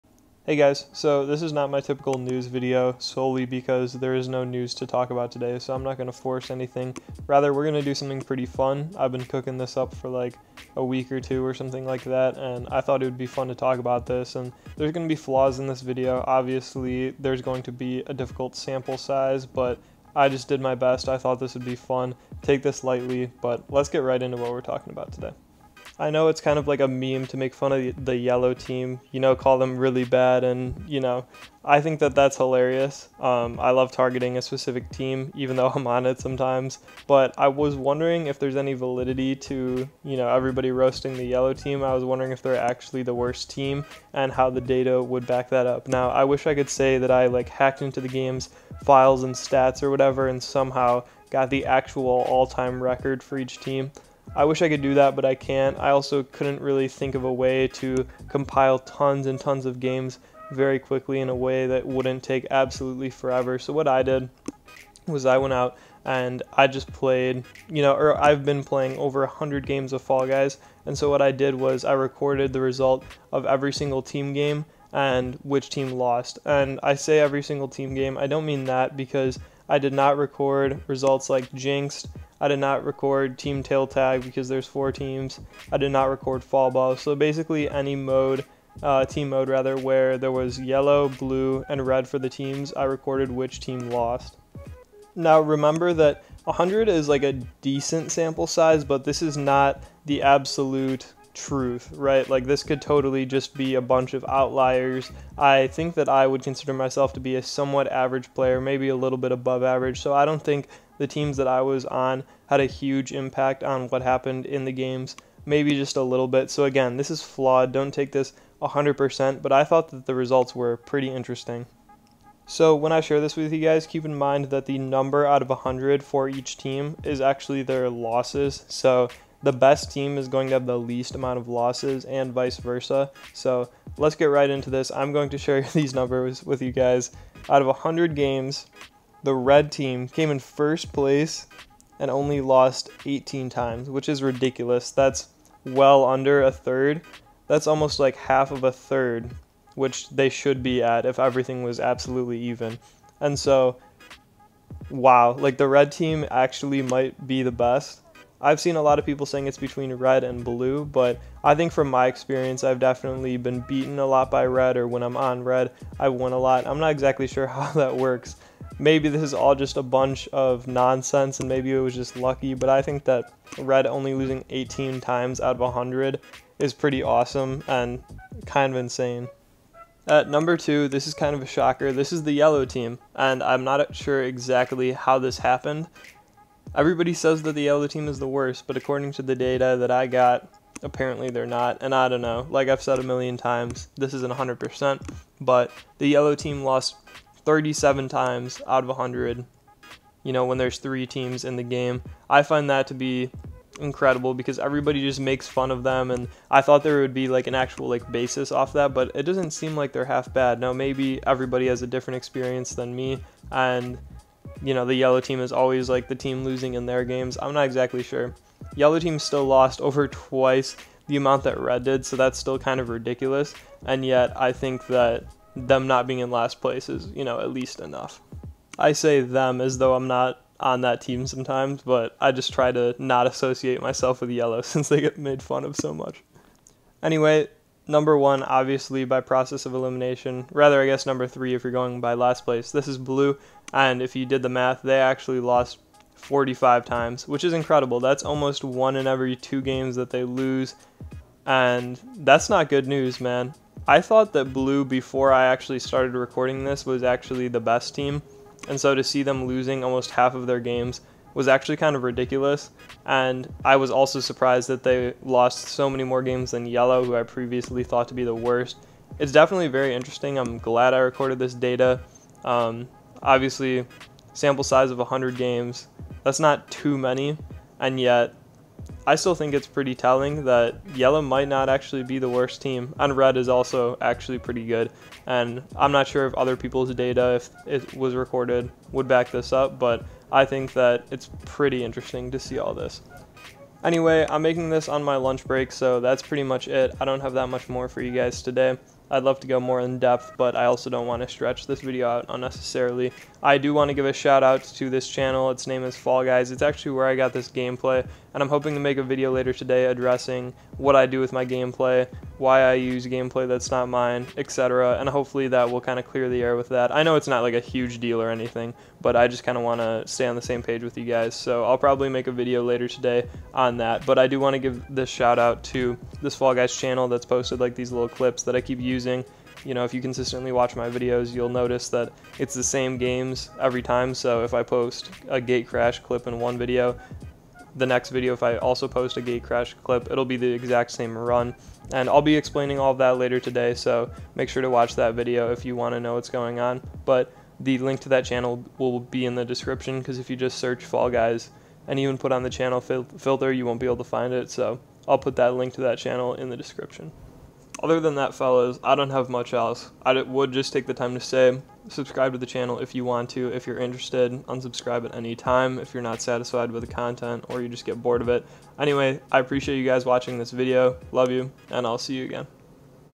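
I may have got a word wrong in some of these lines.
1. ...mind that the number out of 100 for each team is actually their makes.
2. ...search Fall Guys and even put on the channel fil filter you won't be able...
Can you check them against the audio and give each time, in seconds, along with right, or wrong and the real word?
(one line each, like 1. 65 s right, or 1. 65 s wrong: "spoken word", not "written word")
1. 124 s wrong: "losses", not "makes"
2. 350 s right.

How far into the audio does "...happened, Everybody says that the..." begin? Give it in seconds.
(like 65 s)
185 s.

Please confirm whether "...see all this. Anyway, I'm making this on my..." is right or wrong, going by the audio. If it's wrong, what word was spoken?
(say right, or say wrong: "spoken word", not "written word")
right.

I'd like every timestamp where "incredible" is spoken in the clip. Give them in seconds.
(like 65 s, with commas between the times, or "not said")
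203 s, 247 s.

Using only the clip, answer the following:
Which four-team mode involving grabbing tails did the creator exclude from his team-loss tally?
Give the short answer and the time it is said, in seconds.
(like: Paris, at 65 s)
Team tail tag, at 83 s.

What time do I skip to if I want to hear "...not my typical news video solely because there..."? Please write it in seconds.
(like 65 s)
1 s.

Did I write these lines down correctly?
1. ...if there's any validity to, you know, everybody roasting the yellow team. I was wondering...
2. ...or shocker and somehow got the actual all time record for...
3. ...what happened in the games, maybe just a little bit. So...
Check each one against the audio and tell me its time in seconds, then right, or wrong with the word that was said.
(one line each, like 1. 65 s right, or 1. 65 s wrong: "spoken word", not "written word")
1. 38 s right
2. 49 s wrong: "whatever", not "shocker"
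3. 113 s right.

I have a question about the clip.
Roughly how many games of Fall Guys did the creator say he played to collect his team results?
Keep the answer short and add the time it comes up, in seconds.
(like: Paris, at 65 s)
over 100, at 68 s.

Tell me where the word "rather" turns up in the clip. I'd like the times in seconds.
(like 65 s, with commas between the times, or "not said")
7 s, 89 s, 240 s.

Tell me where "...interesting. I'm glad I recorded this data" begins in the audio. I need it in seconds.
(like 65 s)
269 s.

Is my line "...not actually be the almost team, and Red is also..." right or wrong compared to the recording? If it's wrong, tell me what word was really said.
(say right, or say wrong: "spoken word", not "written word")
wrong: "worst", not "almost".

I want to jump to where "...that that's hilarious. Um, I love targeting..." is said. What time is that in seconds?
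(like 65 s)
31 s.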